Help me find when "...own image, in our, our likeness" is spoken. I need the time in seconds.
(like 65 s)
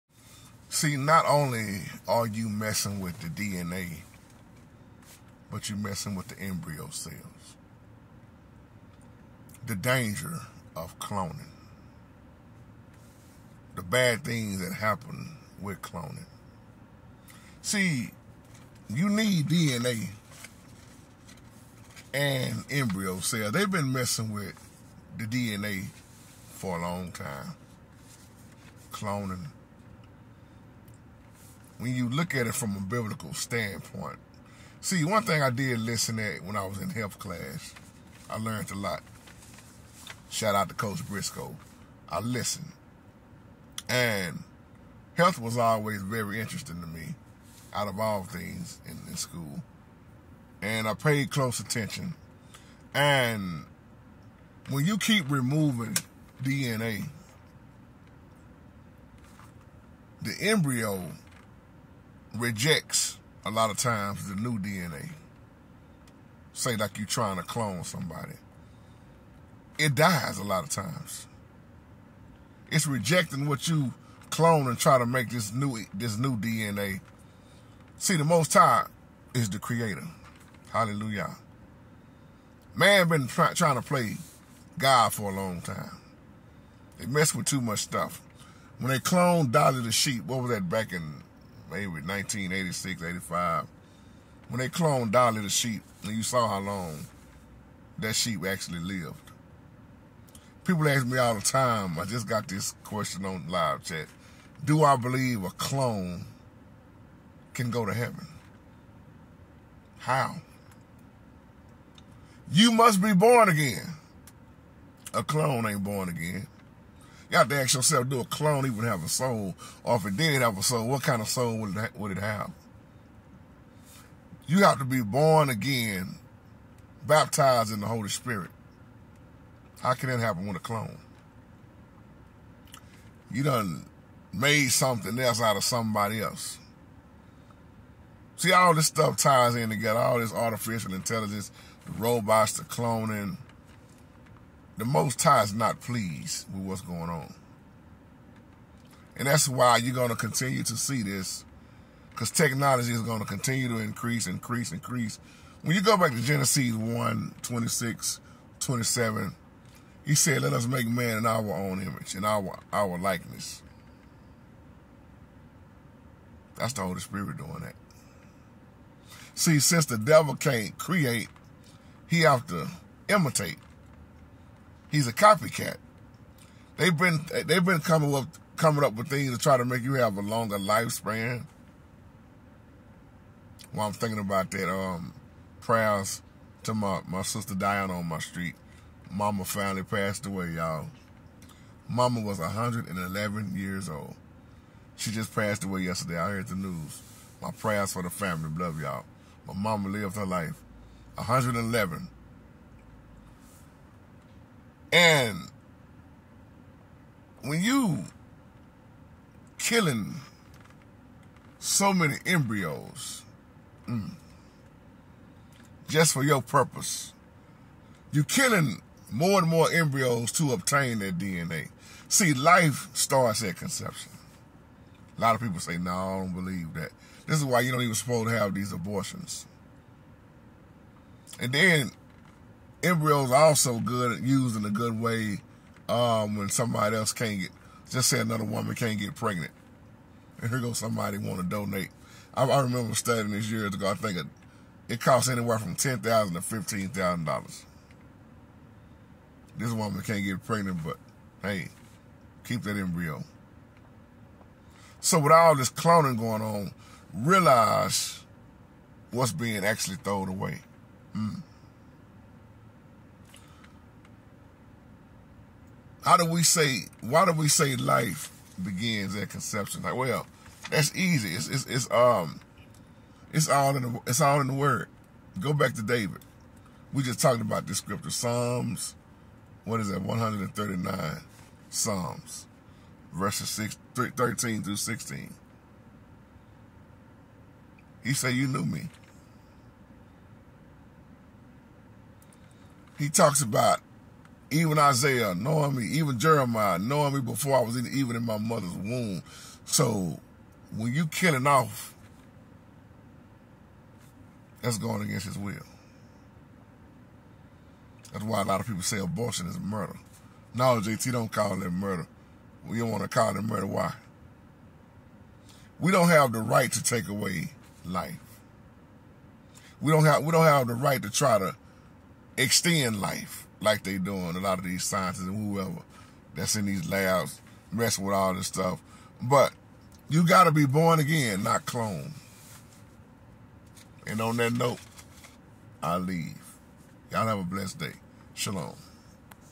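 161 s.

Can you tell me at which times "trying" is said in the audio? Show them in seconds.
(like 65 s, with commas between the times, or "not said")
67 s, 83 s.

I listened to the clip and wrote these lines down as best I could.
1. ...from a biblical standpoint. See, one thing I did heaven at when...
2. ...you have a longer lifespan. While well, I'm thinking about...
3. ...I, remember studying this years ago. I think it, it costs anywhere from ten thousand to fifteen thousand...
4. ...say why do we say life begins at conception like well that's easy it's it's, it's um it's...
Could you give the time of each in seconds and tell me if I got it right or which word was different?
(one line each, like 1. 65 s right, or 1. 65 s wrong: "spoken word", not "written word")
1. 32 s wrong: "listen", not "heaven"
2. 179 s right
3. 242 s right
4. 266 s right.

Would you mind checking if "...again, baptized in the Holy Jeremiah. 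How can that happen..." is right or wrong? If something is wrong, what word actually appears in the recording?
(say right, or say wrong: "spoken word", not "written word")
wrong: "Spirit", not "Jeremiah".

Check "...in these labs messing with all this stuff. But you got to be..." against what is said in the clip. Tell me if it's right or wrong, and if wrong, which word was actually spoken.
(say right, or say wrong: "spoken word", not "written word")
right.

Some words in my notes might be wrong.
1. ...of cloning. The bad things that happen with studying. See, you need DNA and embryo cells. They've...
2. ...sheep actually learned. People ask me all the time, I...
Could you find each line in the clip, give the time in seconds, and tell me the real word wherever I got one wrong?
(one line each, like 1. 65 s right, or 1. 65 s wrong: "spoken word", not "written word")
1. 10 s wrong: "cloning", not "studying"
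2. 98 s wrong: "lived", not "learned".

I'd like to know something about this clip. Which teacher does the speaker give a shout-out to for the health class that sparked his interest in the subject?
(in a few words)
Coach Briscoe.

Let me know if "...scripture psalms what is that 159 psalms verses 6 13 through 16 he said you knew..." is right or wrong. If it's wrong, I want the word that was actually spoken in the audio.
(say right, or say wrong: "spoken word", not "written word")
wrong: "139", not "159".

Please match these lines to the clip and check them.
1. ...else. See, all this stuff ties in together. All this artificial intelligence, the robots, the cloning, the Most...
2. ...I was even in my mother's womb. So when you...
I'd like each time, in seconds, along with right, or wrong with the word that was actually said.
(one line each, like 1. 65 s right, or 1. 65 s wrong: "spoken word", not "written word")
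1. 136 s right
2. 297 s right.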